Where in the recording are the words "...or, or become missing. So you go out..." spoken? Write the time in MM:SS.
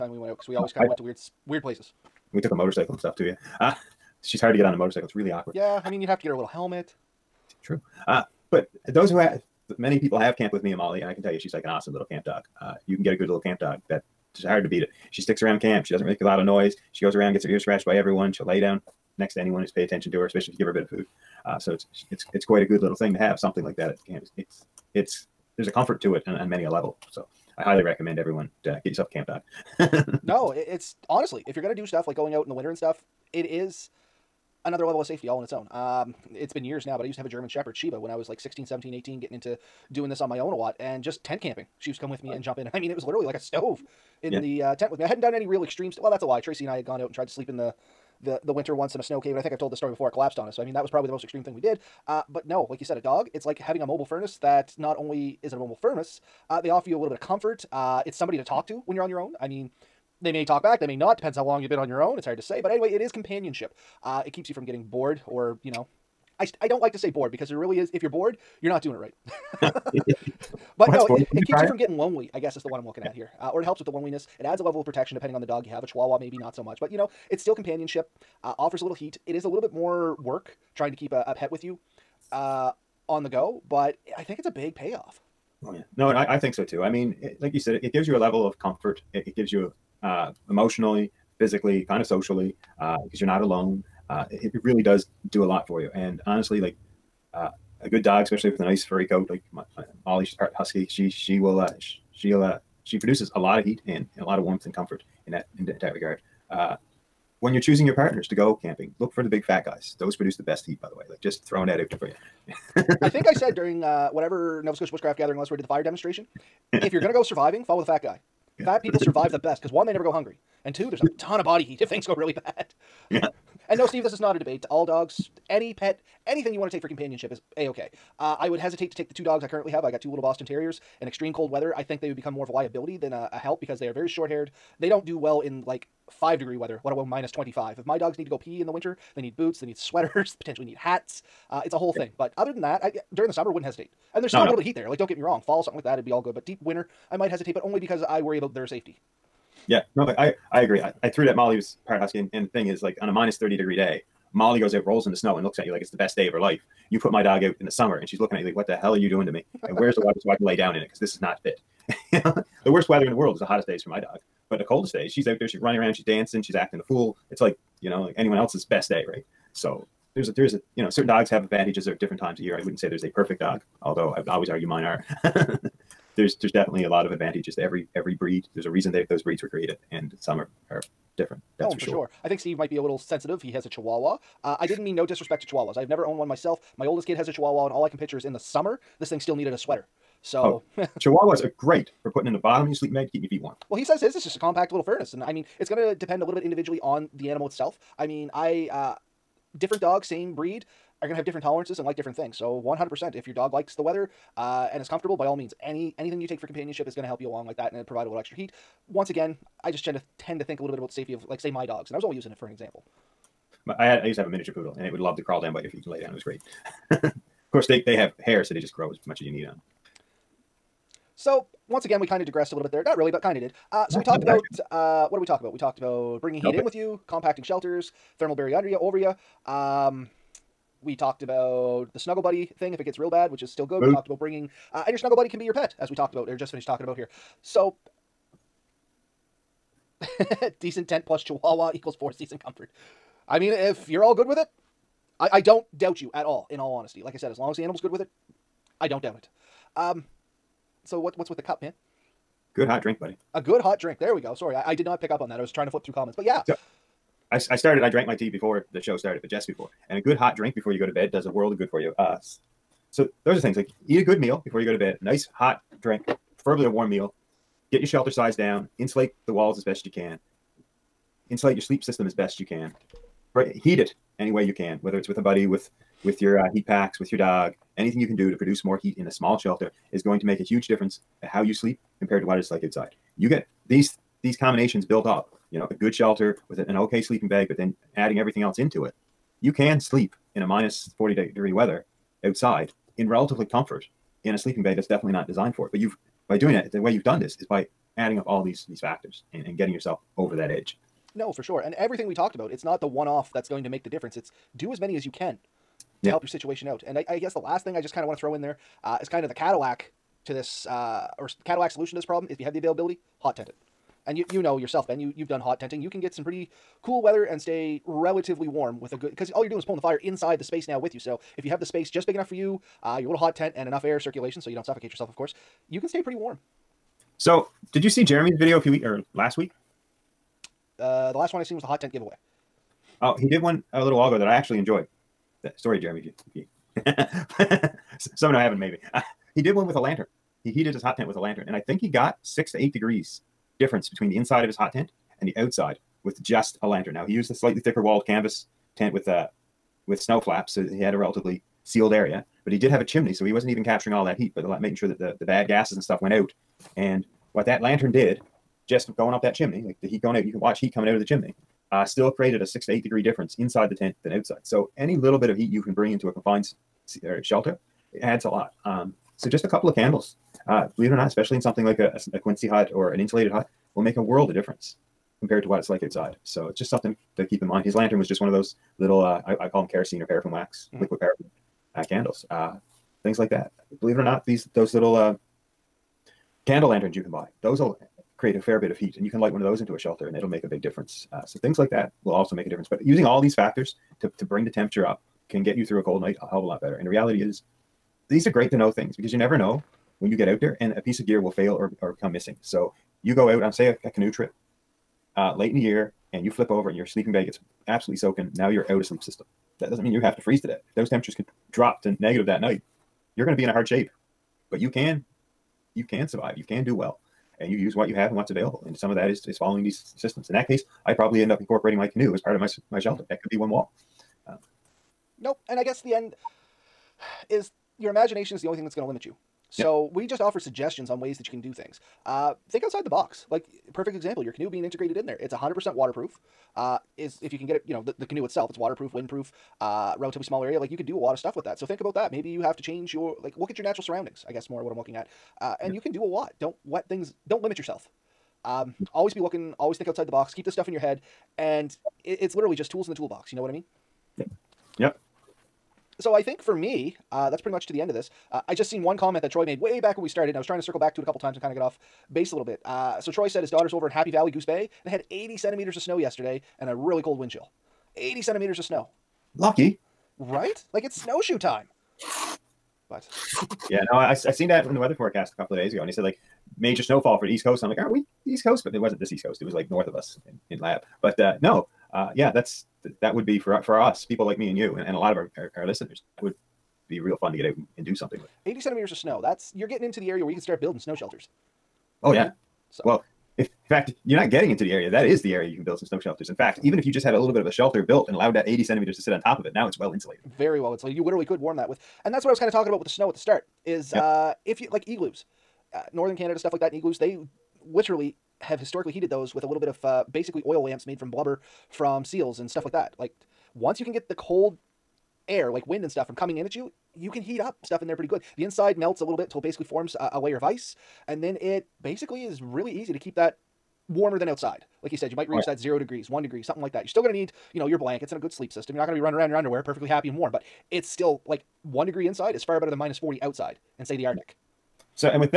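06:41.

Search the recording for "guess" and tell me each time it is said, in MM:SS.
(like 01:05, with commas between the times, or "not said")
01:12, 05:07, 07:05, 07:24.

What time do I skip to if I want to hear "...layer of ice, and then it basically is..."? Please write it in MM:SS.
08:40.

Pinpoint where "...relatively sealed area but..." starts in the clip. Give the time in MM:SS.
05:50.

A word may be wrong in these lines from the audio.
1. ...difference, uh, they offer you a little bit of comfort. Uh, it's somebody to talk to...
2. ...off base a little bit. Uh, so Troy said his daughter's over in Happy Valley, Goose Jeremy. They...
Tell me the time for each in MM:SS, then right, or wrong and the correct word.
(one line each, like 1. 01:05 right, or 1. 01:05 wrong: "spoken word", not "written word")
1. 00:55 wrong: "furnace", not "difference"
2. 07:41 wrong: "Bay", not "Jeremy".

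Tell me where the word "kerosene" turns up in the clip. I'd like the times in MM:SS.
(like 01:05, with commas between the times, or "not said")
06:19.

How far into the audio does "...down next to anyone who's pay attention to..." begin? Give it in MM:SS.
00:18.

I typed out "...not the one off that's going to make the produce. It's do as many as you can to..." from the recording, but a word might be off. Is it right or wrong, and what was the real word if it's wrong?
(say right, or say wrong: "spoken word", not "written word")
wrong: "difference", not "produce".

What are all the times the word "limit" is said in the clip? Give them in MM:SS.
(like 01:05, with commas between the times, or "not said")
07:08, 07:27.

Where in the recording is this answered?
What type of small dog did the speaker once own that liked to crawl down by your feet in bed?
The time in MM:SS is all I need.
03:34.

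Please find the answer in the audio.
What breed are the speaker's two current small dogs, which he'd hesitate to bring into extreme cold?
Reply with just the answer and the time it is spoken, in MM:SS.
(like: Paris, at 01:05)
Boston Terriers, at 02:10.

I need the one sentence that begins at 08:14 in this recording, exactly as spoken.
That is the area you can build some snow shelters.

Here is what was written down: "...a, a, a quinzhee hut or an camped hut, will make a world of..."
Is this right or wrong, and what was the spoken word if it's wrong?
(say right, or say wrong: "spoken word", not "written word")
wrong: "insulated", not "camped".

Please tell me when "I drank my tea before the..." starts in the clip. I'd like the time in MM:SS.
04:17.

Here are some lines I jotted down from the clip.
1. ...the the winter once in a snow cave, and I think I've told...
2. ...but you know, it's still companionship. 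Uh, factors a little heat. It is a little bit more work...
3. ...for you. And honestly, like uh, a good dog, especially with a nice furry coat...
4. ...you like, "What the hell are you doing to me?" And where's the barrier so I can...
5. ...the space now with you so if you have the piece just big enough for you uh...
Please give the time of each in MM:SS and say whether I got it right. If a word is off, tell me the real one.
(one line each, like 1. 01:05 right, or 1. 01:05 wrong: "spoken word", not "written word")
1. 00:48 right
2. 01:16 wrong: "offers", not "factors"
3. 01:35 right
4. 02:38 wrong: "water", not "barrier"
5. 05:20 wrong: "space", not "piece".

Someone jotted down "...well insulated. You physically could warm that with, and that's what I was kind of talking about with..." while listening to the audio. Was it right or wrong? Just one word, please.
wrong.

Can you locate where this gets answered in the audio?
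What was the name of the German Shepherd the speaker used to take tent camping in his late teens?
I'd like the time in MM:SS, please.
00:37.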